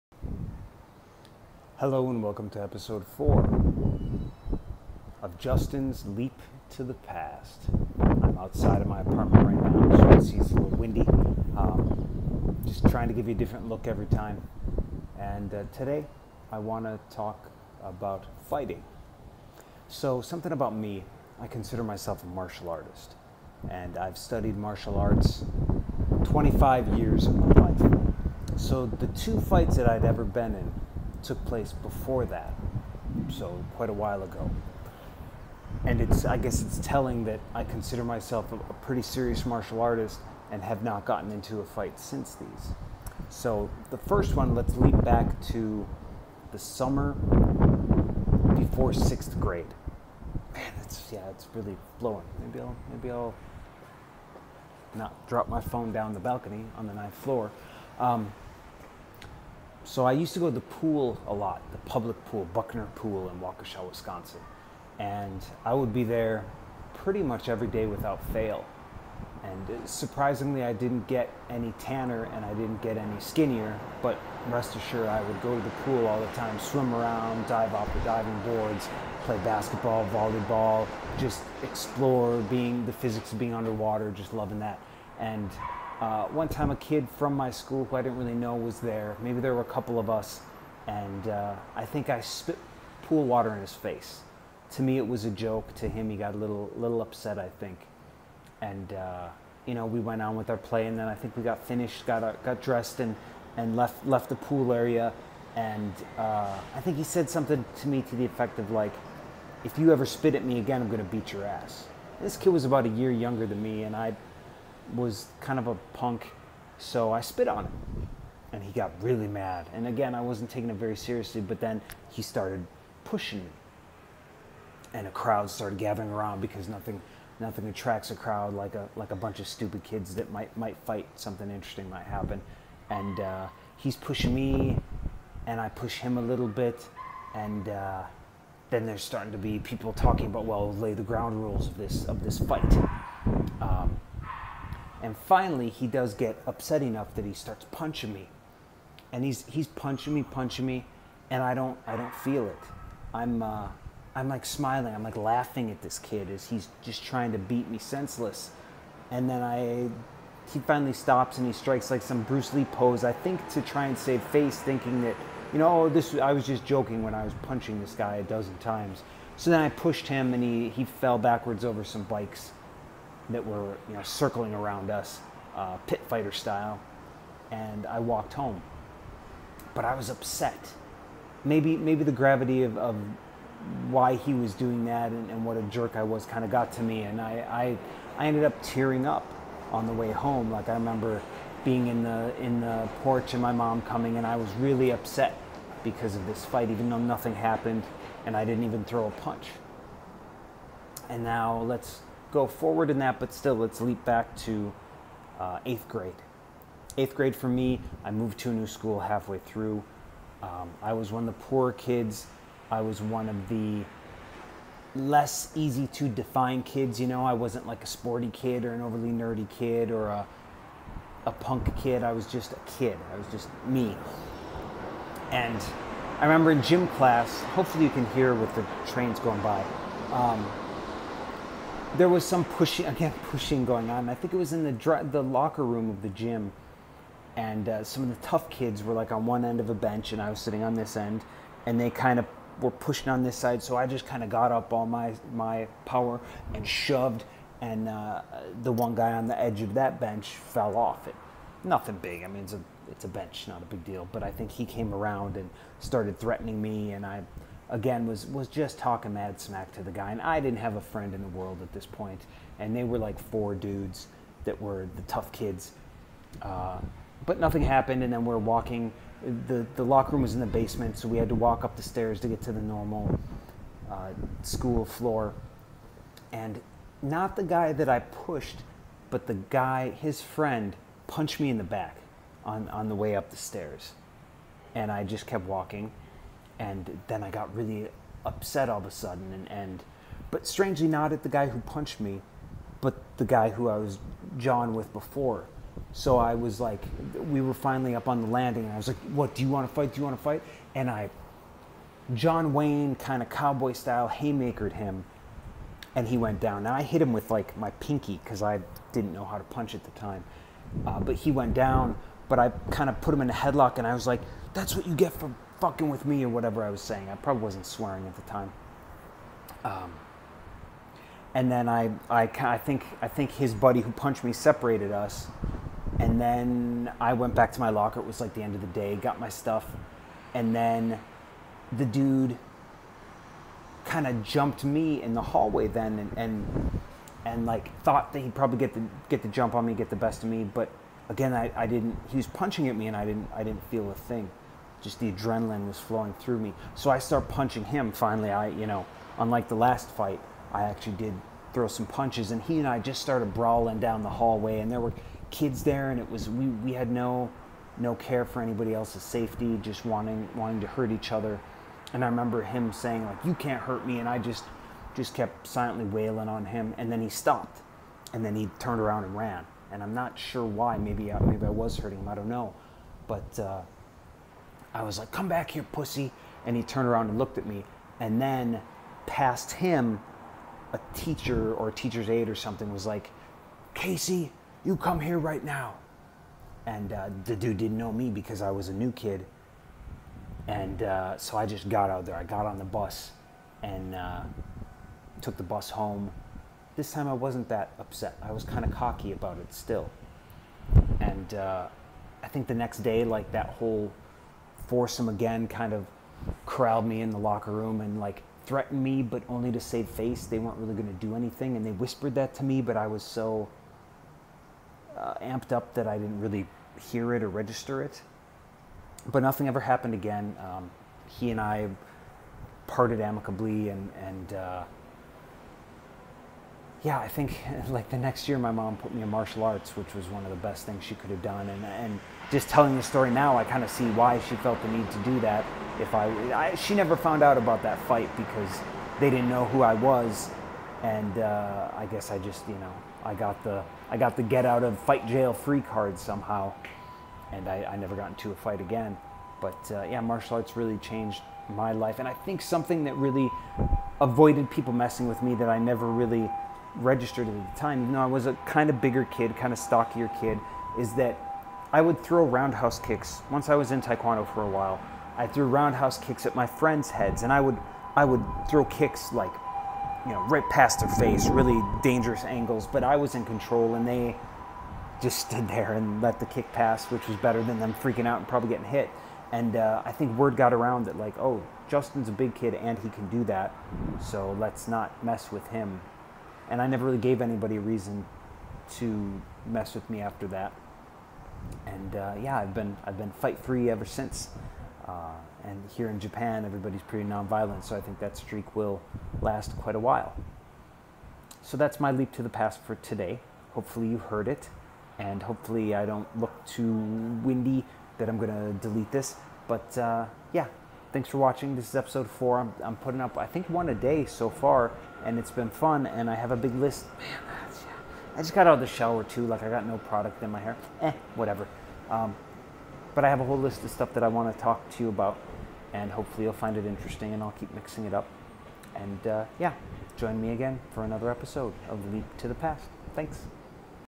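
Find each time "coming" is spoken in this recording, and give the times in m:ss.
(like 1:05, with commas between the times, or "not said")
3:13.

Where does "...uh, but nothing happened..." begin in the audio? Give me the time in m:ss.
4:26.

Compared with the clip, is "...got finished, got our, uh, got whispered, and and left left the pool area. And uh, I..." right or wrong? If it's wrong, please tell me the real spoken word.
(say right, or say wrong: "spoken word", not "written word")
wrong: "dressed", not "whispered".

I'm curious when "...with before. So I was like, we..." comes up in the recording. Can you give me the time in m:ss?
4:54.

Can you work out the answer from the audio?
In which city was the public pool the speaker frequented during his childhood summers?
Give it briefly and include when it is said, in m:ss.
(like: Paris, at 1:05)
Waukesha, Wisconsin, at 1:03.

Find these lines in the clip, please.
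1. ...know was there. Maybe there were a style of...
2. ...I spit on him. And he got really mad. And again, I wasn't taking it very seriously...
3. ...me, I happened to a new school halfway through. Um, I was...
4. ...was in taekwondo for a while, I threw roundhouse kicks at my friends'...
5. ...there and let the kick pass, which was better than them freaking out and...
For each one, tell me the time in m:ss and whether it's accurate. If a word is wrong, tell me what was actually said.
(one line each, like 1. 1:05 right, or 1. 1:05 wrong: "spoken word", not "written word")
1. 1:28 wrong: "couple", not "style"
2. 1:57 right
3. 3:27 wrong: "moved", not "happened"
4. 7:43 right
5. 7:55 right.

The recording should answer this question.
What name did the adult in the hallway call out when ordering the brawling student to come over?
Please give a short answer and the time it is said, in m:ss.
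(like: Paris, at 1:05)
Casey, at 6:23.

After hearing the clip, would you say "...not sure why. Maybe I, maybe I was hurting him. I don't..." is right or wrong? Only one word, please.
right.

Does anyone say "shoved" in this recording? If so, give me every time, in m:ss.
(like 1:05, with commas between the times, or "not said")
4:06.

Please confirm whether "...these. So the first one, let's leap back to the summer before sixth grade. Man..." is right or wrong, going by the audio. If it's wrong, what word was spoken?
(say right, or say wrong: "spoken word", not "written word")
right.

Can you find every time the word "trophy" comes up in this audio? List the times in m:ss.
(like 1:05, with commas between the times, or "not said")
not said.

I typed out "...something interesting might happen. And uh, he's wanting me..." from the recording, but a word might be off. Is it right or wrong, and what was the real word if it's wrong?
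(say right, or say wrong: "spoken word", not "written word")
wrong: "pushing", not "wanting".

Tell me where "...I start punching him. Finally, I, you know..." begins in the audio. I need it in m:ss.
5:46.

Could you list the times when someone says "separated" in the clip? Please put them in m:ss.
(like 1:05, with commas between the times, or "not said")
5:24.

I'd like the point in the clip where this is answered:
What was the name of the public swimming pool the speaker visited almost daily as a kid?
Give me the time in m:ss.
1:02.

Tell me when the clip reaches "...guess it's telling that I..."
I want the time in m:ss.
0:36.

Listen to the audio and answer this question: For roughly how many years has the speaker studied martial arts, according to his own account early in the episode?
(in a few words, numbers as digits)
25 years.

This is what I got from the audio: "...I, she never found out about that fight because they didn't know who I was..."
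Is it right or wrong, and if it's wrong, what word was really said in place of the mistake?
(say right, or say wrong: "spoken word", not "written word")
right.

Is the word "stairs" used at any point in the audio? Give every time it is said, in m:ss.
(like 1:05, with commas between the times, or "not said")
4:31, 4:43.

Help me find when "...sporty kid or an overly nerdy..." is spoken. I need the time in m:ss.
3:37.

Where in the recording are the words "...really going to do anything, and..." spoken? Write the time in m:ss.
6:50.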